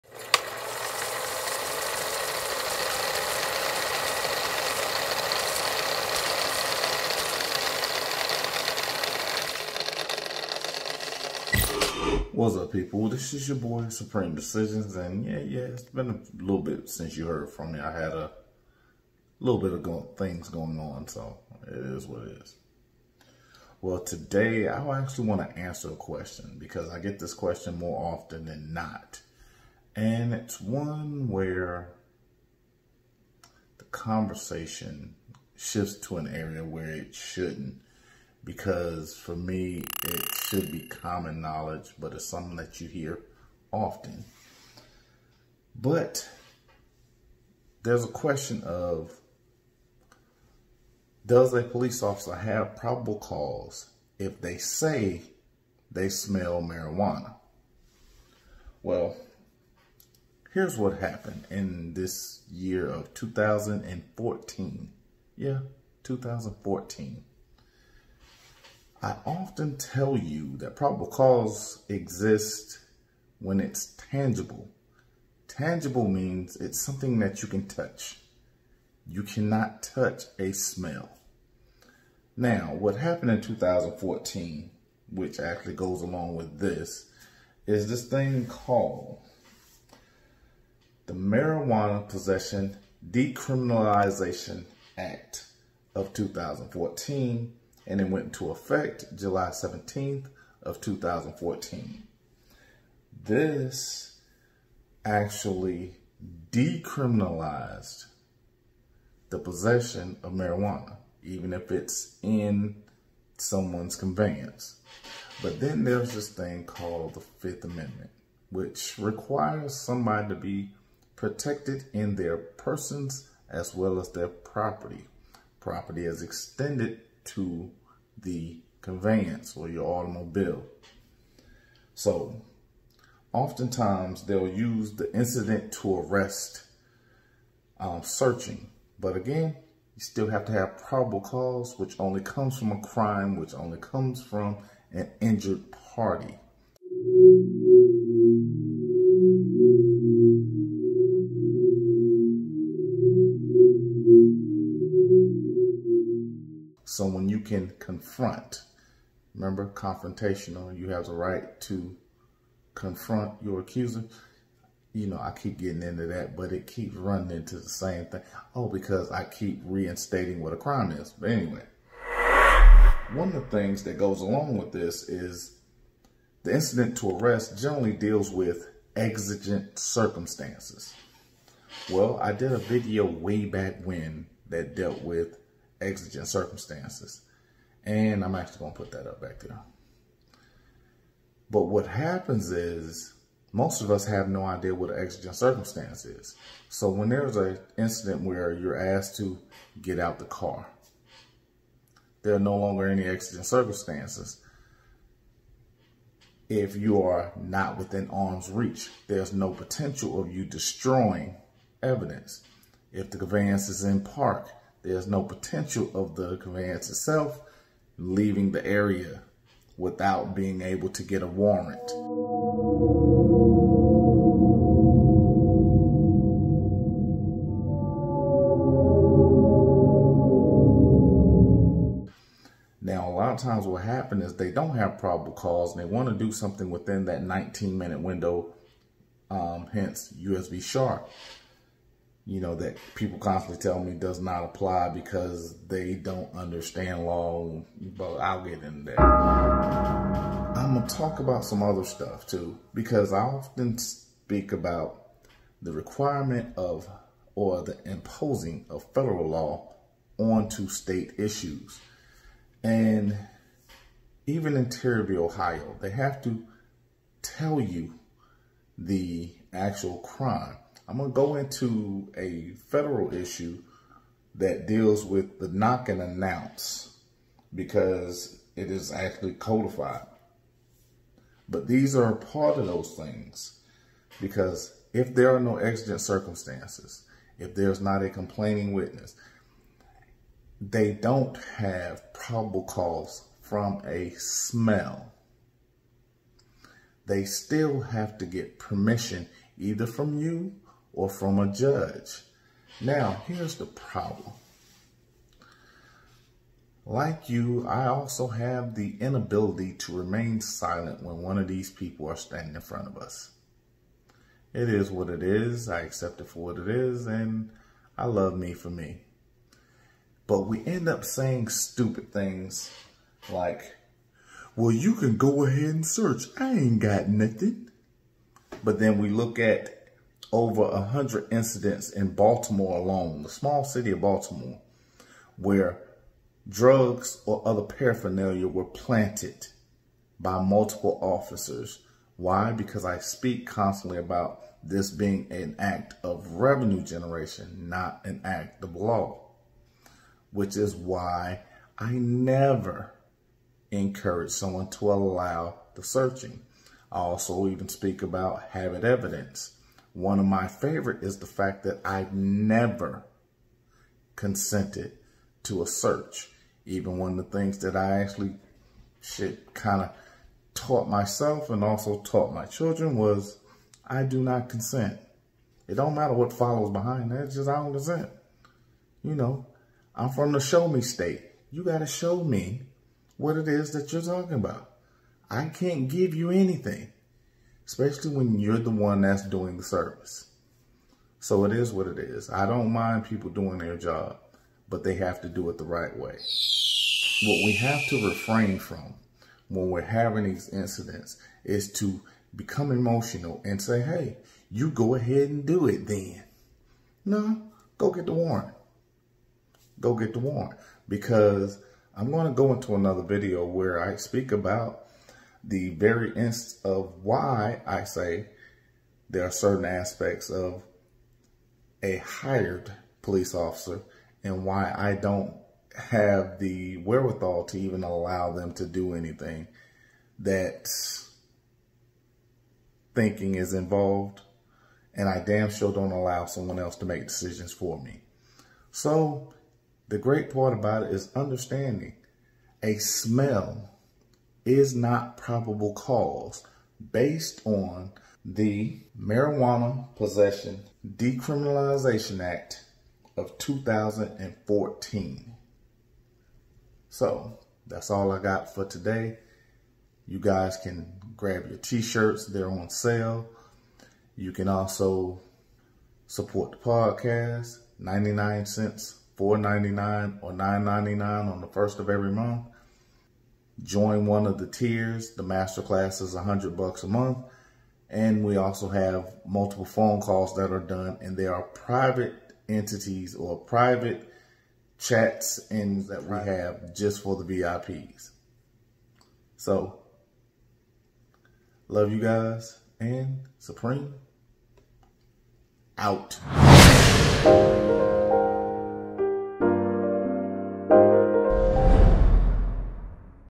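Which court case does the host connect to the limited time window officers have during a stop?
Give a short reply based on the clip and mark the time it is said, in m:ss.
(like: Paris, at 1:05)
U.S. v. Sharpe, at 4:00.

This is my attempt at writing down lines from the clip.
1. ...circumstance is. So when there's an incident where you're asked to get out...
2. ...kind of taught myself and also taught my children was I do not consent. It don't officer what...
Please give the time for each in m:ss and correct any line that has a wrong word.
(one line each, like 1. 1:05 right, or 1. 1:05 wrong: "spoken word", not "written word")
1. 3:15 right
2. 6:09 wrong: "matter", not "officer".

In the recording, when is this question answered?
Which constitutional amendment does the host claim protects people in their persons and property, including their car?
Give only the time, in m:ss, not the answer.
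1:57.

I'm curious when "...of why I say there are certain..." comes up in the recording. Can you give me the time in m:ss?
6:56.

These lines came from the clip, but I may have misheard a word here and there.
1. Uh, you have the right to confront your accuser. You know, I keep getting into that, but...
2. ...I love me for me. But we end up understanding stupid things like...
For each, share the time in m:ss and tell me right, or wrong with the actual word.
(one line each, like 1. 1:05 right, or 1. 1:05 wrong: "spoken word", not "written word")
1. 2:40 right
2. 5:17 wrong: "saying", not "understanding".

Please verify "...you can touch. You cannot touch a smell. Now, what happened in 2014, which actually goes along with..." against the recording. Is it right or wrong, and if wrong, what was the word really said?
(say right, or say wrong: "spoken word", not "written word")
right.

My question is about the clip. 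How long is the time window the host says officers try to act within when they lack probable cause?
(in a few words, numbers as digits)
19 minutes.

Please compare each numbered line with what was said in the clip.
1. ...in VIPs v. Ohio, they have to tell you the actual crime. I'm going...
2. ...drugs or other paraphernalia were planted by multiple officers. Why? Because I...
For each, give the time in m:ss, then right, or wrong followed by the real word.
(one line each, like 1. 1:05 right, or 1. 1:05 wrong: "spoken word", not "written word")
1. 4:24 wrong: "Terry", not "VIPs"
2. 5:36 right.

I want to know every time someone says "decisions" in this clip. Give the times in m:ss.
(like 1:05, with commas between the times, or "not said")
0:14, 7:17.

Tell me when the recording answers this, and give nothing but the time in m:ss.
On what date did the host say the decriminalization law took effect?
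1:39.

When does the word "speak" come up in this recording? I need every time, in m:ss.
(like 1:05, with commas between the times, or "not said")
4:13, 5:42, 5:57, 6:53.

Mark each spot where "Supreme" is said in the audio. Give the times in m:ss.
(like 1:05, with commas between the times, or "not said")
0:13, 8:13.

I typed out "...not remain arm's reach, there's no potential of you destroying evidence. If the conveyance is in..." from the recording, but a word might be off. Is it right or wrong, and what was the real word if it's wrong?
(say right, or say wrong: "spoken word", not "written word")
wrong: "within", not "remain".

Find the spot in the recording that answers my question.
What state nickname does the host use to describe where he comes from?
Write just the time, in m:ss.
6:20.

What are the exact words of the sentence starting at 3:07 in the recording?
And I'm actually going to put that up back there.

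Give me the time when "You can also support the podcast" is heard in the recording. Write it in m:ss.
7:44.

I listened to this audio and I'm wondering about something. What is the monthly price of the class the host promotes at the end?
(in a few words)
$100.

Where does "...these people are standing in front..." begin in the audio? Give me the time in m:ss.
5:11.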